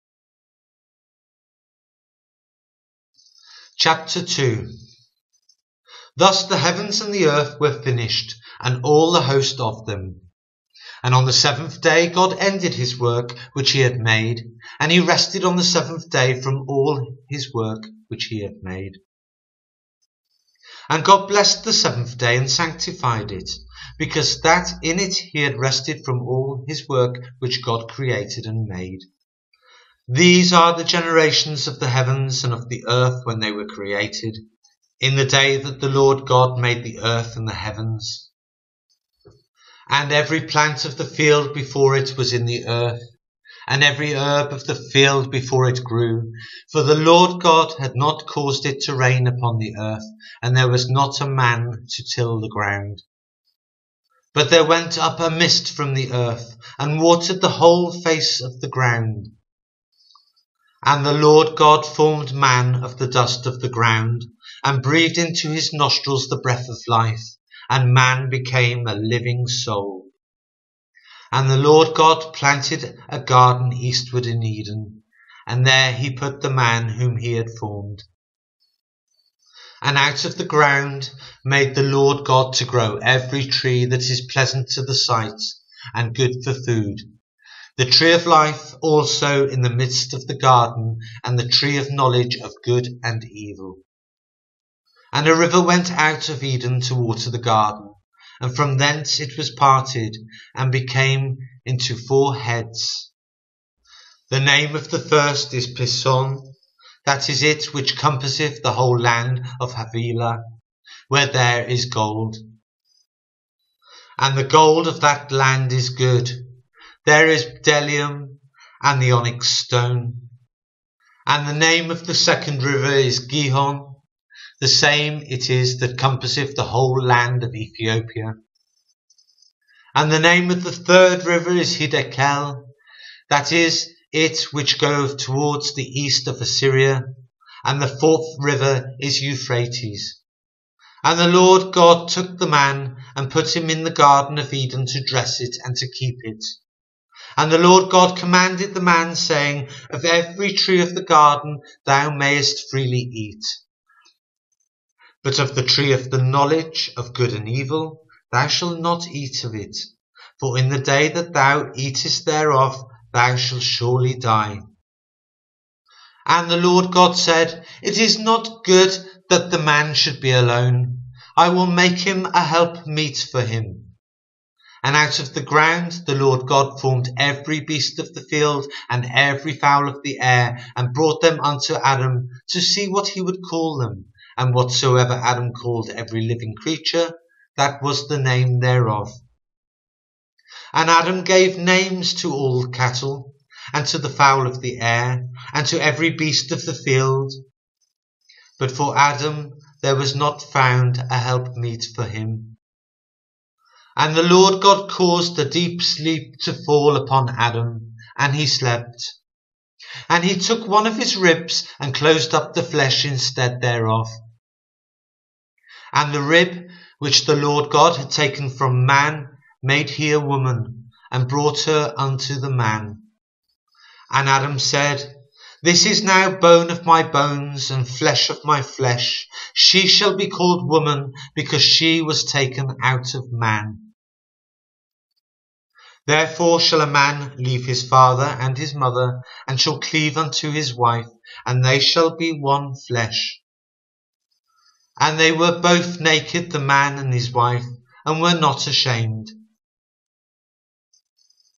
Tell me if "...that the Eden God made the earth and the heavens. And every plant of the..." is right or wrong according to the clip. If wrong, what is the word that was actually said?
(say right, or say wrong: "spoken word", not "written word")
wrong: "Lord", not "Eden".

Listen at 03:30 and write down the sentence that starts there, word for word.
And he took one of his ribs and closed up the flesh instead thereof.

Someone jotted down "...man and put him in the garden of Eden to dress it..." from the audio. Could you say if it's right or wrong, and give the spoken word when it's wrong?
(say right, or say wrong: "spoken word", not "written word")
right.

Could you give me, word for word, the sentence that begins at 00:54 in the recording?
But there went up a mist from the earth, and watered the whole face of the ground.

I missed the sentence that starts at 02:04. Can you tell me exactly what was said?
The same it is that compasseth the whole land of Ethiopia.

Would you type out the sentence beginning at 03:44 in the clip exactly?
And Adam said, this is now bone of my bones and flesh of my flesh.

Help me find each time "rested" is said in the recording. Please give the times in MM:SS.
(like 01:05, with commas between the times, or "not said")
00:14, 00:25.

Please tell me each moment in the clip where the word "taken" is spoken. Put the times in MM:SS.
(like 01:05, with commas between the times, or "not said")
03:38, 03:52.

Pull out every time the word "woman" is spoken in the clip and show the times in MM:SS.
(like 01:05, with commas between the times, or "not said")
03:40, 03:50.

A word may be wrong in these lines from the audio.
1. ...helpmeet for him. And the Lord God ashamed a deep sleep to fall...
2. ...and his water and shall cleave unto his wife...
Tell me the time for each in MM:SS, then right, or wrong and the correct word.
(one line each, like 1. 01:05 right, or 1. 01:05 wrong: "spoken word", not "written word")
1. 03:21 wrong: "caused", not "ashamed"
2. 03:58 wrong: "mother", not "water".